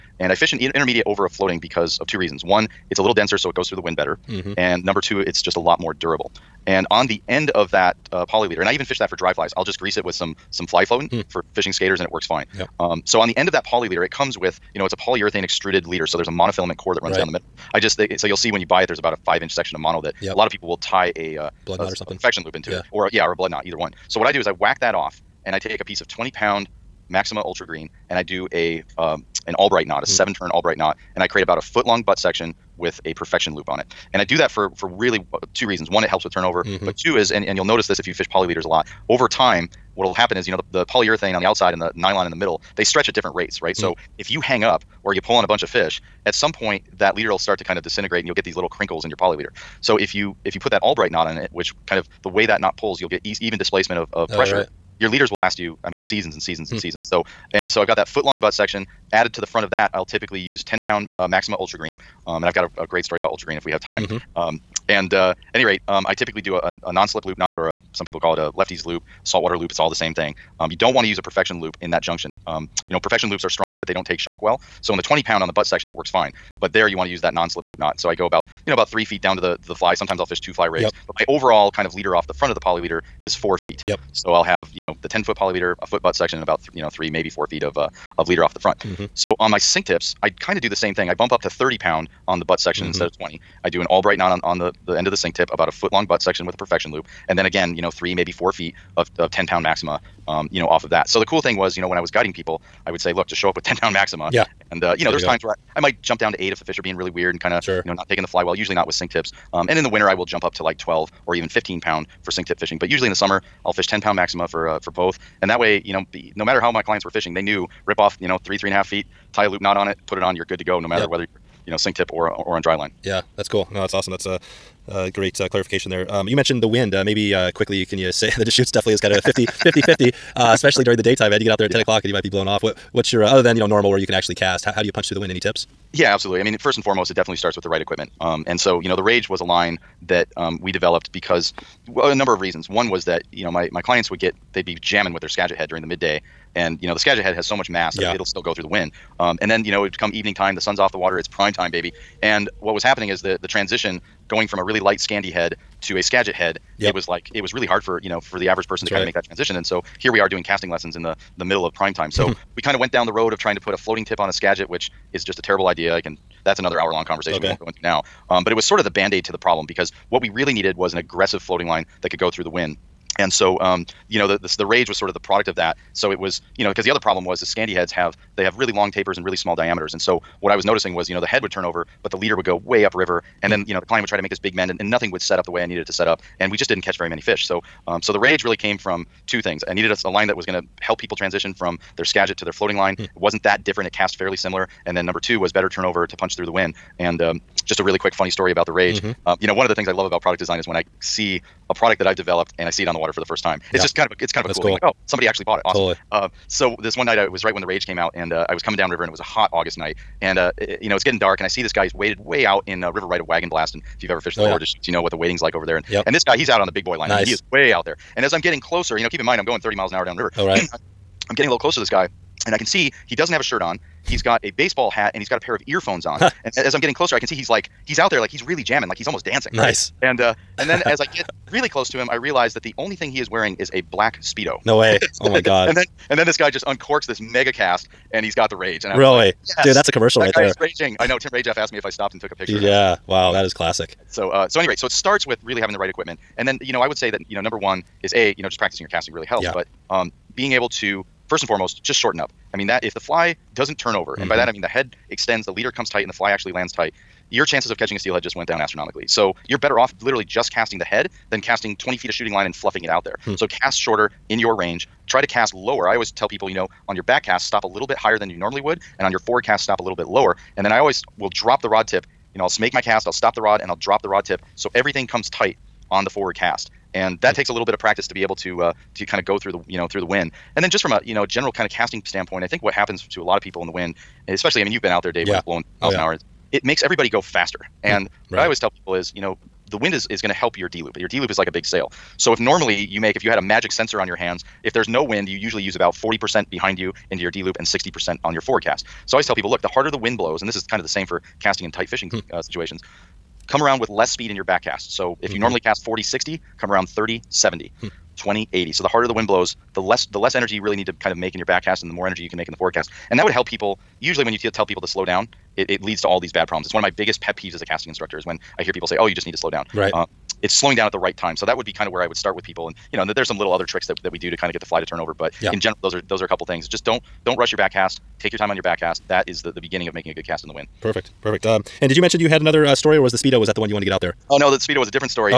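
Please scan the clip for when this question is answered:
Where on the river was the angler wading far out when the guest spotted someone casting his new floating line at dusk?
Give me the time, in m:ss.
3:33.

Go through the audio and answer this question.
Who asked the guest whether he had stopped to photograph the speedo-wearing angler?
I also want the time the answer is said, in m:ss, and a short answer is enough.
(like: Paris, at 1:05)
Tim Rajeff, at 4:01.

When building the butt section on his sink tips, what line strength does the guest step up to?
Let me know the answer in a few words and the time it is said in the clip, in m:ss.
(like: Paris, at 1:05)
30 pound, at 1:31.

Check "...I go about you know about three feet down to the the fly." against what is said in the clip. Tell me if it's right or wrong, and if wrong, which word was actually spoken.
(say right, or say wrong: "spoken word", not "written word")
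right.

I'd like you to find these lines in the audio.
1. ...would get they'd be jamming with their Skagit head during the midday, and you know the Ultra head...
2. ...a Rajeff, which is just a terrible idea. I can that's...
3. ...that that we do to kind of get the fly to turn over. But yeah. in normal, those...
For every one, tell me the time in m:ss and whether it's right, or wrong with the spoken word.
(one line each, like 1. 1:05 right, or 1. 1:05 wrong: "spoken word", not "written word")
1. 2:24 wrong: "Skagit", not "Ultra"
2. 2:44 wrong: "Skagit", not "Rajeff"
3. 5:23 wrong: "general", not "normal".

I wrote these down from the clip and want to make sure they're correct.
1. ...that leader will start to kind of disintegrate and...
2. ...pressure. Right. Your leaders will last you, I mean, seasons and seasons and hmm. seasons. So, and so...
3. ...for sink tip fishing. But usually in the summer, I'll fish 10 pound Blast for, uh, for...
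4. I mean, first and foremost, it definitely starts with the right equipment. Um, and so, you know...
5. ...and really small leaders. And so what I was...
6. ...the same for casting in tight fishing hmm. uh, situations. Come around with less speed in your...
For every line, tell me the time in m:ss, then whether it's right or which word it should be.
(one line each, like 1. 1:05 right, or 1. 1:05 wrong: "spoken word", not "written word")
1. 0:46 right
2. 0:54 right
3. 1:52 wrong: "Maxima", not "Blast"
4. 2:16 right
5. 2:59 wrong: "diameters", not "leaders"
6. 5:00 right.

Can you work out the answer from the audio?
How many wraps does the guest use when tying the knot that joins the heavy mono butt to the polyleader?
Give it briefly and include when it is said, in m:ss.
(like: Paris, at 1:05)
7, at 0:30.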